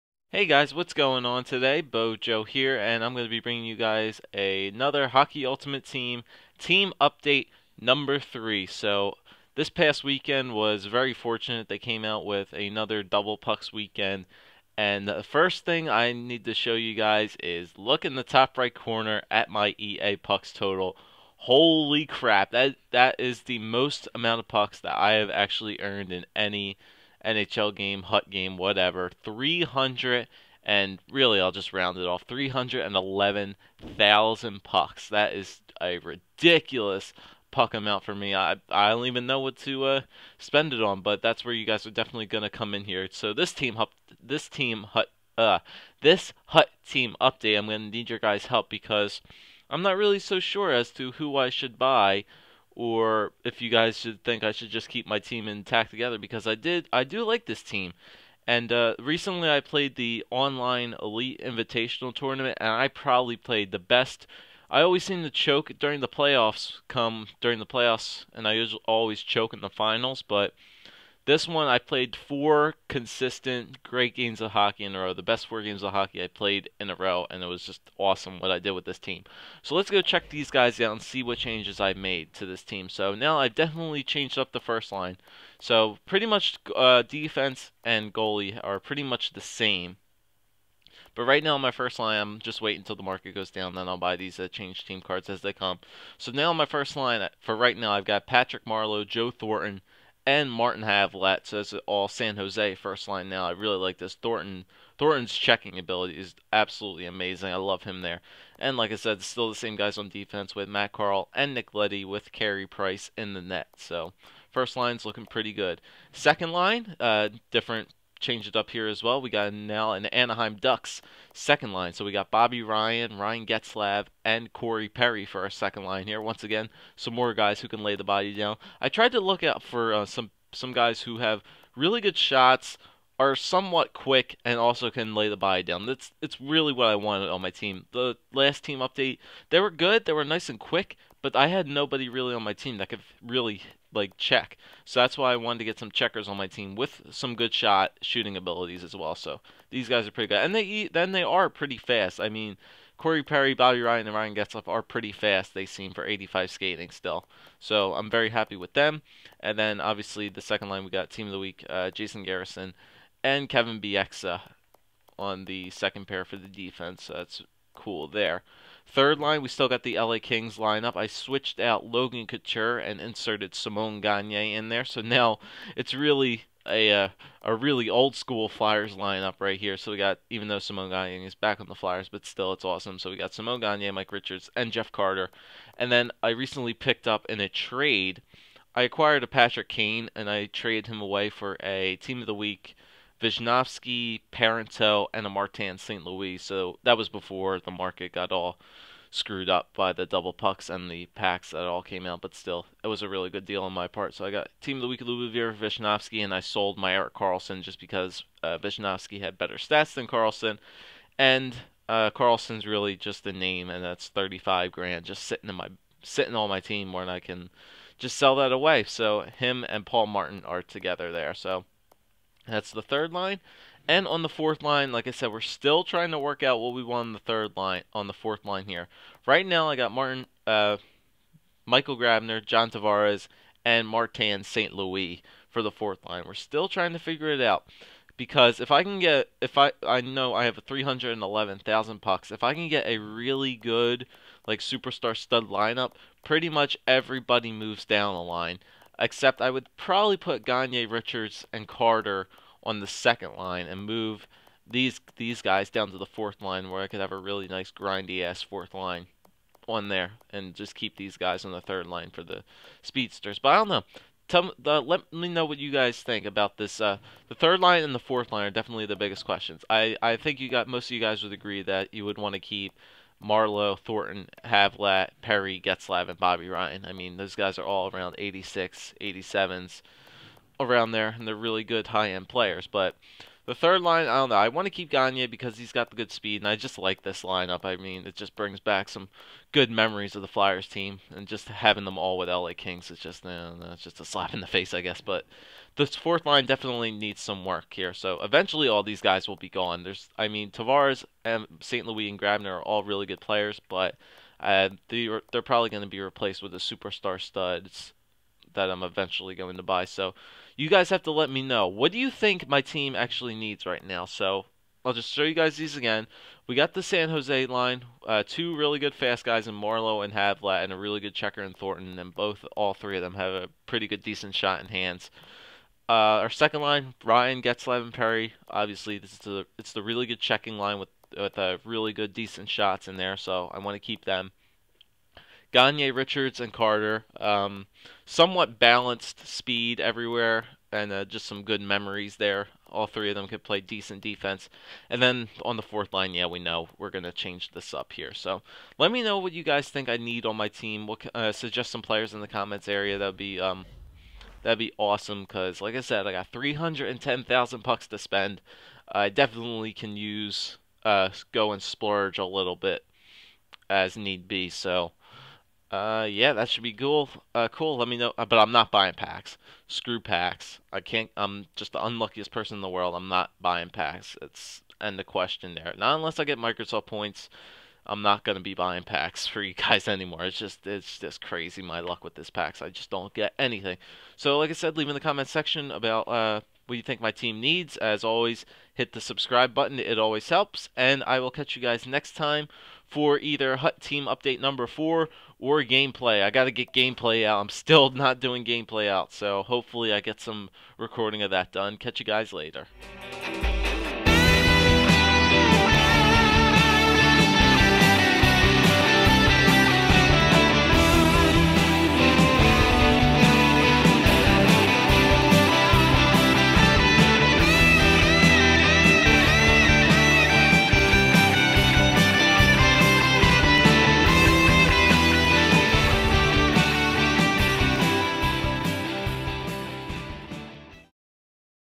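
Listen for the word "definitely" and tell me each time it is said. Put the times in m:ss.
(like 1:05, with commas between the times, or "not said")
0:41, 1:23, 4:28, 4:56, 5:59.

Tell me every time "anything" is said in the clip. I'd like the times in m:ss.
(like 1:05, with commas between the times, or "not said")
6:23.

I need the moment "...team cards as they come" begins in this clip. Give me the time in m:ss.
1:34.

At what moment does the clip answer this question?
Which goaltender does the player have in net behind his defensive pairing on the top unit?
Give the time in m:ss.
1:52.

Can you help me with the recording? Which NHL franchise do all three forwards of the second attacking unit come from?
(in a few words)
Anaheim Ducks.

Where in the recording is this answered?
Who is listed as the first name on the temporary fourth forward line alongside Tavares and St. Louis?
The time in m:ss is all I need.
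3:51.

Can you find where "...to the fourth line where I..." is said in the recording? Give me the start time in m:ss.
4:15.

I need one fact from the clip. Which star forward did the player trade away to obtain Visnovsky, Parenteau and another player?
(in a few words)
Patrick Kane.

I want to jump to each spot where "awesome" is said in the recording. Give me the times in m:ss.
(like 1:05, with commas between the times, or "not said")
1:17, 3:02, 5:54.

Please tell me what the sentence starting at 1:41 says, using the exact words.
So that's all San Jose first line now.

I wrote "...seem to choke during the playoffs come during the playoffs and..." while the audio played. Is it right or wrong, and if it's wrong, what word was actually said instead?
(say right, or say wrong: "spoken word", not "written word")
right.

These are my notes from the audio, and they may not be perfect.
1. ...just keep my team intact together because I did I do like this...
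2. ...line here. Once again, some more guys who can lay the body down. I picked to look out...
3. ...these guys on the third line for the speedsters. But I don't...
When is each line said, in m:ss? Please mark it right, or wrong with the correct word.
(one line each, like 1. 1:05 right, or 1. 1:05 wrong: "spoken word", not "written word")
1. 0:54 right
2. 2:05 wrong: "tried", not "picked"
3. 4:20 right.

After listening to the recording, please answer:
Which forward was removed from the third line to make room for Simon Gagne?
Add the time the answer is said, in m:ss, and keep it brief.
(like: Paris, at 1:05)
Logan Couture, at 2:51.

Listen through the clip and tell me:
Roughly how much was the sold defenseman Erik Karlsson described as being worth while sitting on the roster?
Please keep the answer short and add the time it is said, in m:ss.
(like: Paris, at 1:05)
35 grand, at 3:34.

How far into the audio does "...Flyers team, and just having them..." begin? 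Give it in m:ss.
4:50.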